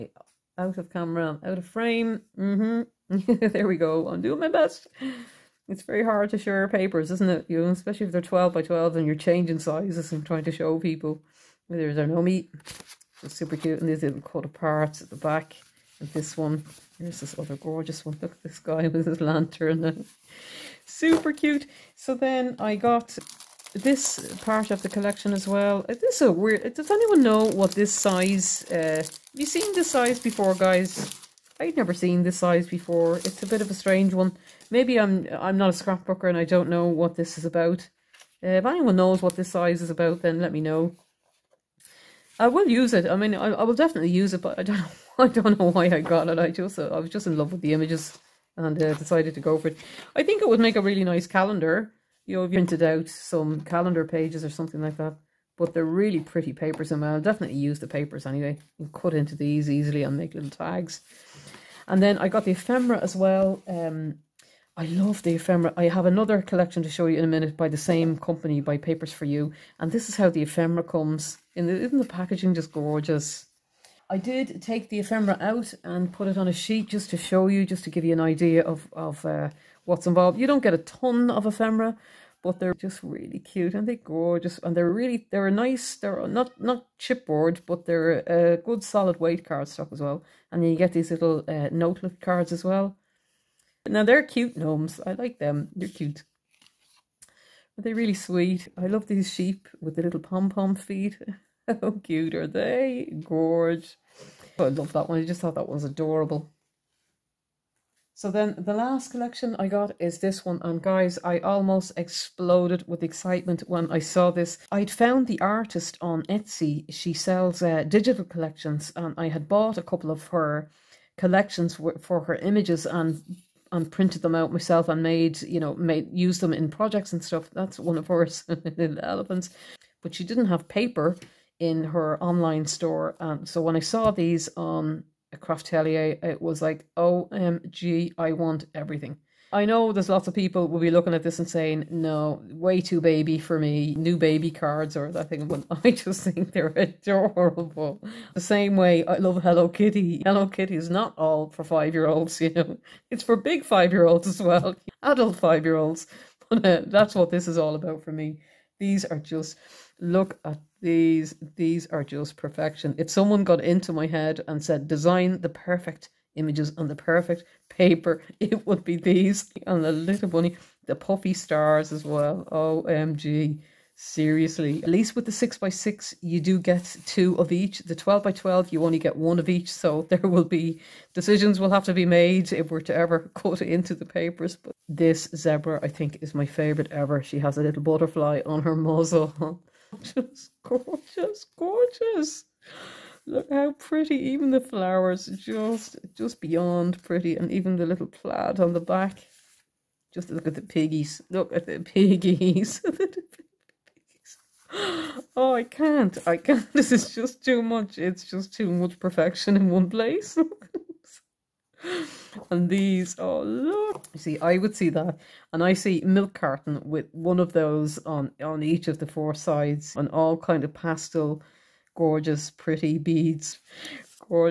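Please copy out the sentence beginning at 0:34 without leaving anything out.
Maybe I'm I'm not a scrapbooker and I don't know what this is about.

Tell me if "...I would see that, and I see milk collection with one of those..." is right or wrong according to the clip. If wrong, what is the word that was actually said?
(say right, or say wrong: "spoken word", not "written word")
wrong: "carton", not "collection".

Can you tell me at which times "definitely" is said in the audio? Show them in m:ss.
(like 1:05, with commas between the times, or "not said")
0:43, 0:57.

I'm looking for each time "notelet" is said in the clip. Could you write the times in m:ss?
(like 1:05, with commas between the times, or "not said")
1:31.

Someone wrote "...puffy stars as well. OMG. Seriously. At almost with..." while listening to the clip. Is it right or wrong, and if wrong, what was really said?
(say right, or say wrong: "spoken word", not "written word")
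wrong: "least", not "almost".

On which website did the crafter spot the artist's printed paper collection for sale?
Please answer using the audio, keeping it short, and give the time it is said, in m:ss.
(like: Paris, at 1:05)
Craftelier, at 2:15.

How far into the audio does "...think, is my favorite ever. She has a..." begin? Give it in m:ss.
3:05.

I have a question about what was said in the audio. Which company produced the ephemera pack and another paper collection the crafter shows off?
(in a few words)
Papers for You.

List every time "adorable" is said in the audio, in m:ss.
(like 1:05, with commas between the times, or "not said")
1:45, 2:26.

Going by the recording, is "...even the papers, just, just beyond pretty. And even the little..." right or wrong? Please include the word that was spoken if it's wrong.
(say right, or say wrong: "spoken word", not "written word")
wrong: "flowers", not "papers".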